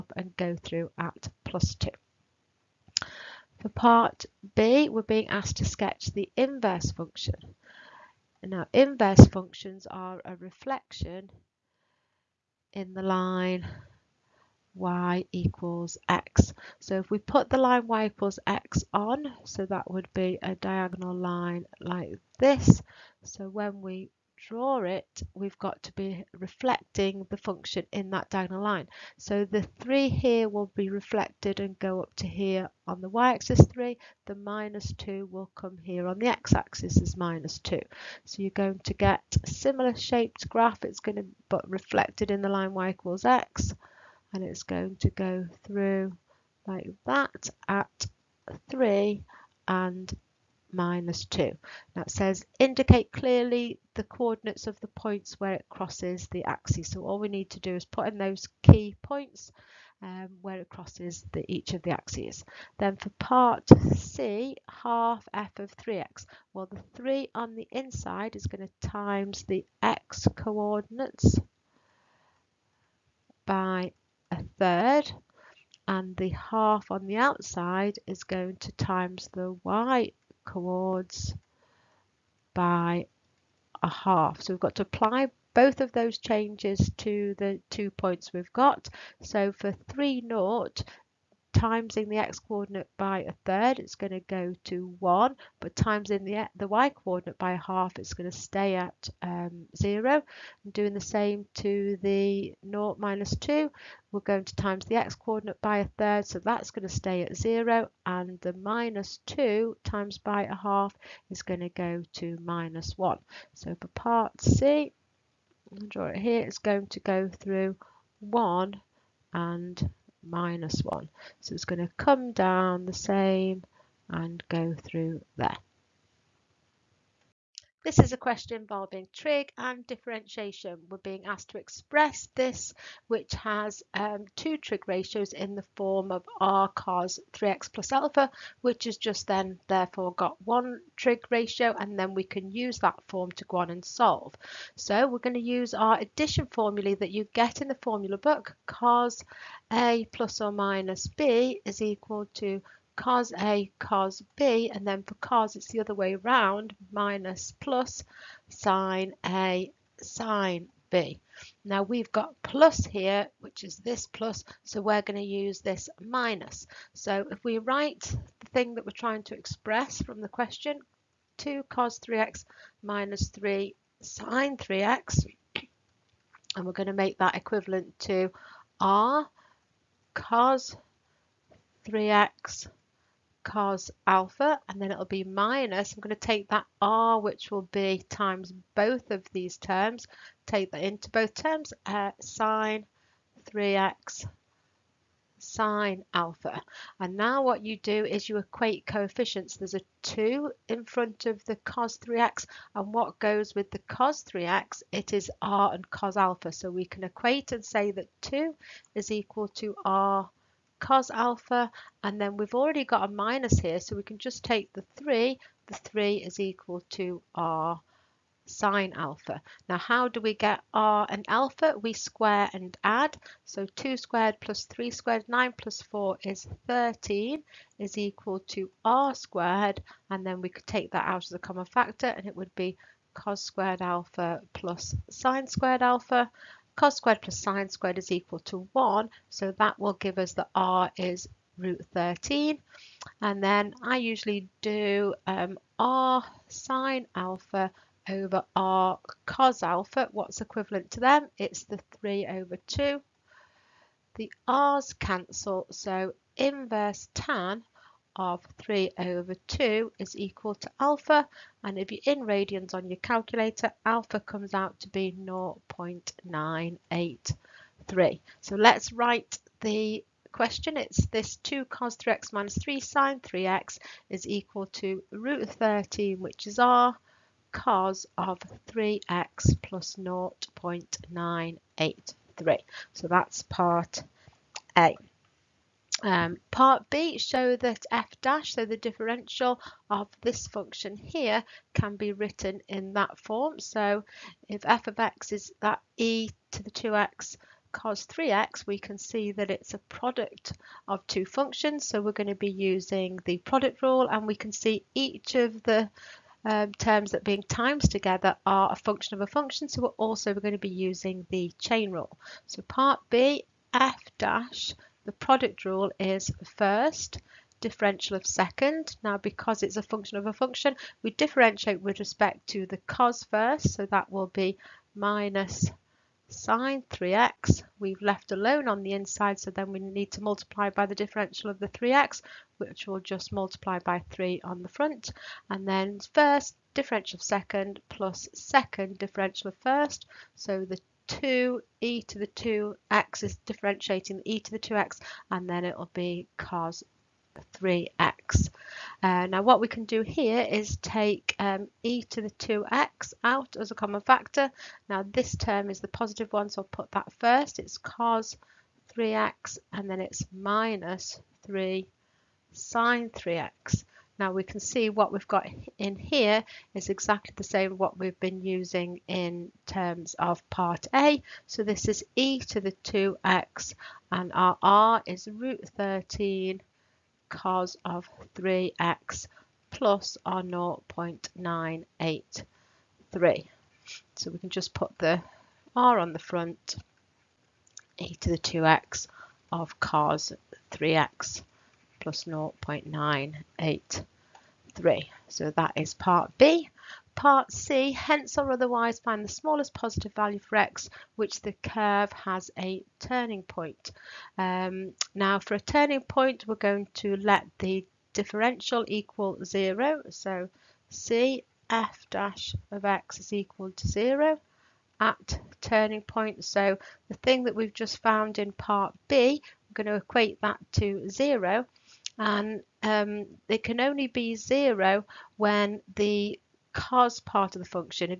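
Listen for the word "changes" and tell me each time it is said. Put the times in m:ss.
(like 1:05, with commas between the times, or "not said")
1:26.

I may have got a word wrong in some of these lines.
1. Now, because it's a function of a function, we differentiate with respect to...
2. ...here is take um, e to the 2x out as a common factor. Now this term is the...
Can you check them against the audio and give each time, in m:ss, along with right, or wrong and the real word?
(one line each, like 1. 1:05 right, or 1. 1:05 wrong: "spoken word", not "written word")
1. 5:19 right
2. 5:50 right.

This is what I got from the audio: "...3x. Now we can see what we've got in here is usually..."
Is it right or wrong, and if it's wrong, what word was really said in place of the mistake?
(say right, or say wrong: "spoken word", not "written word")
wrong: "exactly", not "usually".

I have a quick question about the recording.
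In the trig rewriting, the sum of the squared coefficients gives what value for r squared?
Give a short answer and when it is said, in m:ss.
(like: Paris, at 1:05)
13, at 3:45.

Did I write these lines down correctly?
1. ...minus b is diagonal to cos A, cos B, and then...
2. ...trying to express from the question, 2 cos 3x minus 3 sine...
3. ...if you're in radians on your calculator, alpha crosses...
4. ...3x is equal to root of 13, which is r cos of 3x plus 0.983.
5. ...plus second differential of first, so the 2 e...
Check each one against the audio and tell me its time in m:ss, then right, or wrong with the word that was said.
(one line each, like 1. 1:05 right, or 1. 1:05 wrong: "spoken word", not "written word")
1. 2:30 wrong: "equal", not "diagonal"
2. 2:48 right
3. 4:21 wrong: "comes", not "crosses"
4. 4:33 right
5. 5:37 right.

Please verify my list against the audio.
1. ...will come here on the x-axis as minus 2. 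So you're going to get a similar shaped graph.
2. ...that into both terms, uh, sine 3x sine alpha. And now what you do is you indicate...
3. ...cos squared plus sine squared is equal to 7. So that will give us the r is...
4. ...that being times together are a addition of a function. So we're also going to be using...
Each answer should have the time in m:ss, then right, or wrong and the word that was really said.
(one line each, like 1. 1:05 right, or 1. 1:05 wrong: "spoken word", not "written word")
1. 0:35 right
2. 3:10 wrong: "equate", not "indicate"
3. 3:56 wrong: "1", not "7"
4. 5:07 wrong: "function", not "addition".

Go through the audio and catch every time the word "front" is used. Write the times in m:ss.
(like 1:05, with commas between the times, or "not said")
3:20, 5:34, 6:26.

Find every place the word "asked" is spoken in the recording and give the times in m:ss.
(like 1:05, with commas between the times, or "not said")
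0:05, 2:11.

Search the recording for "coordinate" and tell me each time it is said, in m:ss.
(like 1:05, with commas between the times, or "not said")
0:54, 1:10, 1:32, 1:36, 1:45.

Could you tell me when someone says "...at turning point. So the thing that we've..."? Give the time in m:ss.
6:55.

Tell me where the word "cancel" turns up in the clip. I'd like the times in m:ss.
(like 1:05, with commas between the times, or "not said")
4:14.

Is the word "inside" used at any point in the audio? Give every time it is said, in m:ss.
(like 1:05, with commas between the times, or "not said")
1:07, 5:28.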